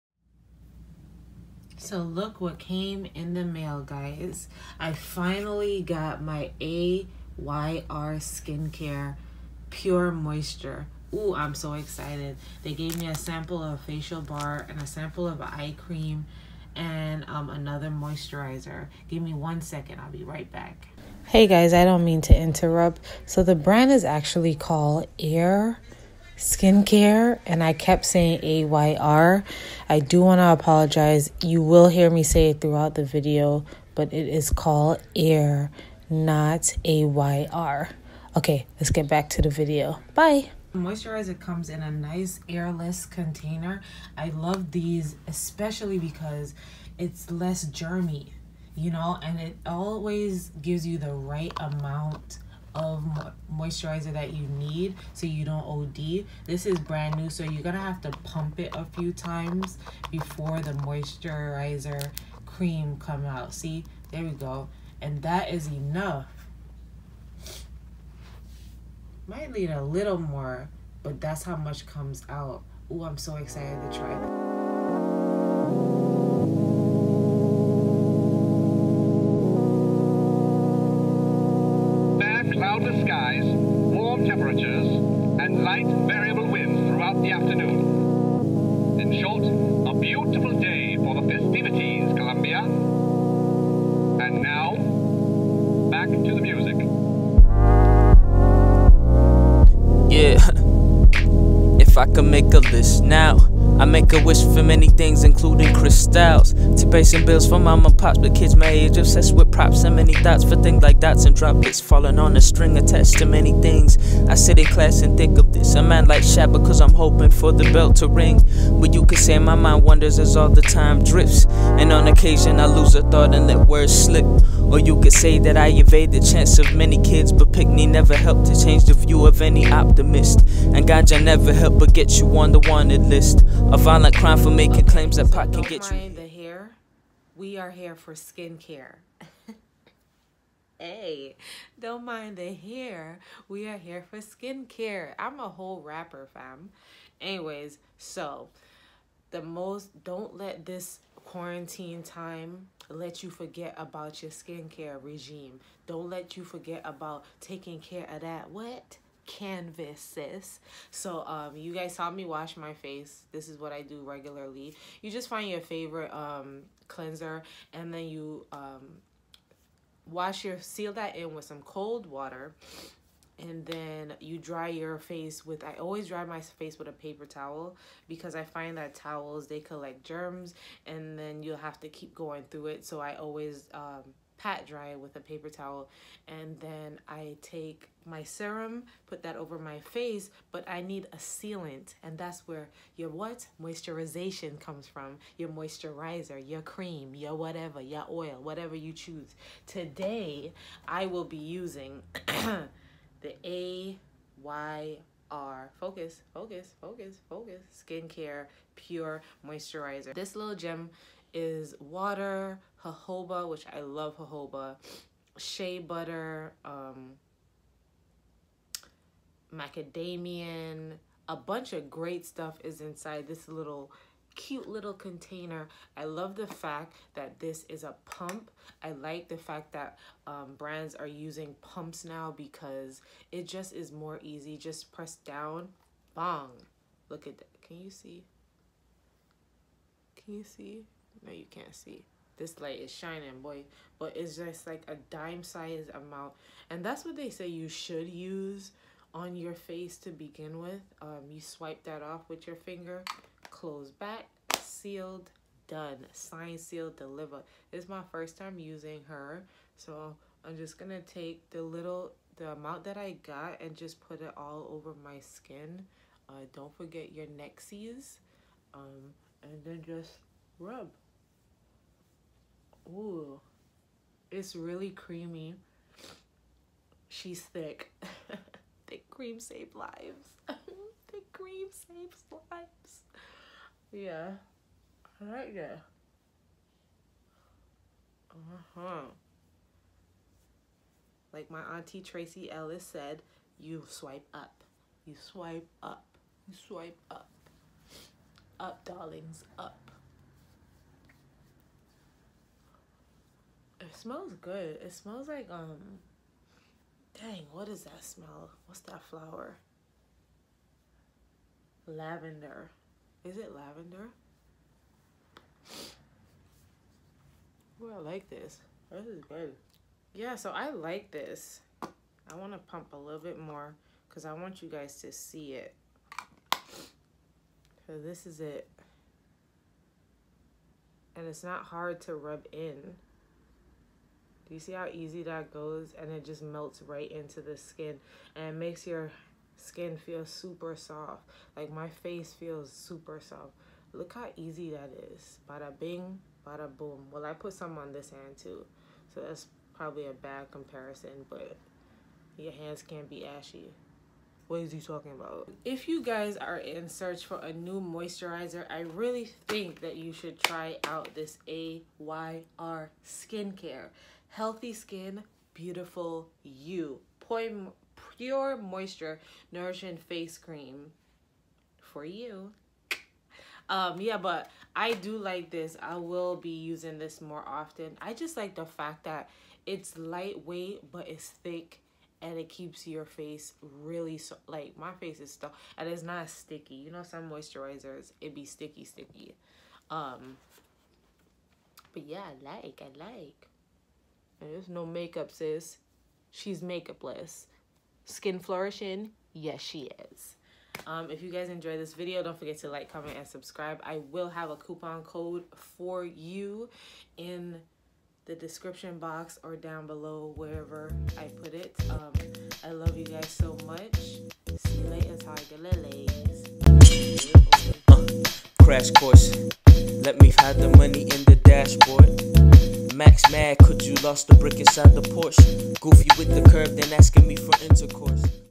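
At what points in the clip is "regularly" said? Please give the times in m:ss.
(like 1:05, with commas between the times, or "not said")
2:44.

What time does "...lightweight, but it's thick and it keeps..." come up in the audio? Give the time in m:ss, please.
6:19.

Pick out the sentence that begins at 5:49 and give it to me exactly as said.
So that's probably a bad comparison, but your hands can't be ashy.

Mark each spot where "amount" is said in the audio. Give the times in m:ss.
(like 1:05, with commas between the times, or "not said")
0:51, 4:05, 4:22.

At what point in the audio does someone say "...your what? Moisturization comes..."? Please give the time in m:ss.
3:12.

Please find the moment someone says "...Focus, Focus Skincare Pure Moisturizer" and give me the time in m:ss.
3:26.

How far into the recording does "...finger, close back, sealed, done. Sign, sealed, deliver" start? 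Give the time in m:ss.
4:12.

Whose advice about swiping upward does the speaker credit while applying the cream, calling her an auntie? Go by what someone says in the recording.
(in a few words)
Tracee Ellis.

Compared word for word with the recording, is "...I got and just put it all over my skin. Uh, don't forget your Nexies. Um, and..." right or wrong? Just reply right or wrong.
right.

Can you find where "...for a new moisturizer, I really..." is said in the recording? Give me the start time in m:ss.
5:57.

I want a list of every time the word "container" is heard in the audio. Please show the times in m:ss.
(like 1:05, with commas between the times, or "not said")
0:43, 3:44.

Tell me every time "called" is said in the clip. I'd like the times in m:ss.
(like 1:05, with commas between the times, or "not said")
0:24, 0:34.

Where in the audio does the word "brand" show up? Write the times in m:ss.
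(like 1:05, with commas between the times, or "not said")
0:23, 0:56, 3:50.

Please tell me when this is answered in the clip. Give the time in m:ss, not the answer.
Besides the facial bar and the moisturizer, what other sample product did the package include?
0:15.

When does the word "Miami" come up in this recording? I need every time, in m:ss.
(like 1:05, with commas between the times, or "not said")
not said.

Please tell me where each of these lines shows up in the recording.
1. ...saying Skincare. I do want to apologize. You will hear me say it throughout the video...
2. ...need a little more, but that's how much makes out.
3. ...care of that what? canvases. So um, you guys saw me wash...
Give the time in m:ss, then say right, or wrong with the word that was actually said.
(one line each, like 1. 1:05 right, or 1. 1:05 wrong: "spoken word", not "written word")
1. 0:28 wrong: "AYR", not "Skincare"
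2. 1:09 wrong: "comes", not "makes"
3. 2:37 right.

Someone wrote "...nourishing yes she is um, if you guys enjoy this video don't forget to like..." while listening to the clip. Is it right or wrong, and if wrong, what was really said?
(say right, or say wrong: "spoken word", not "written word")
wrong: "flourishing", not "nourishing".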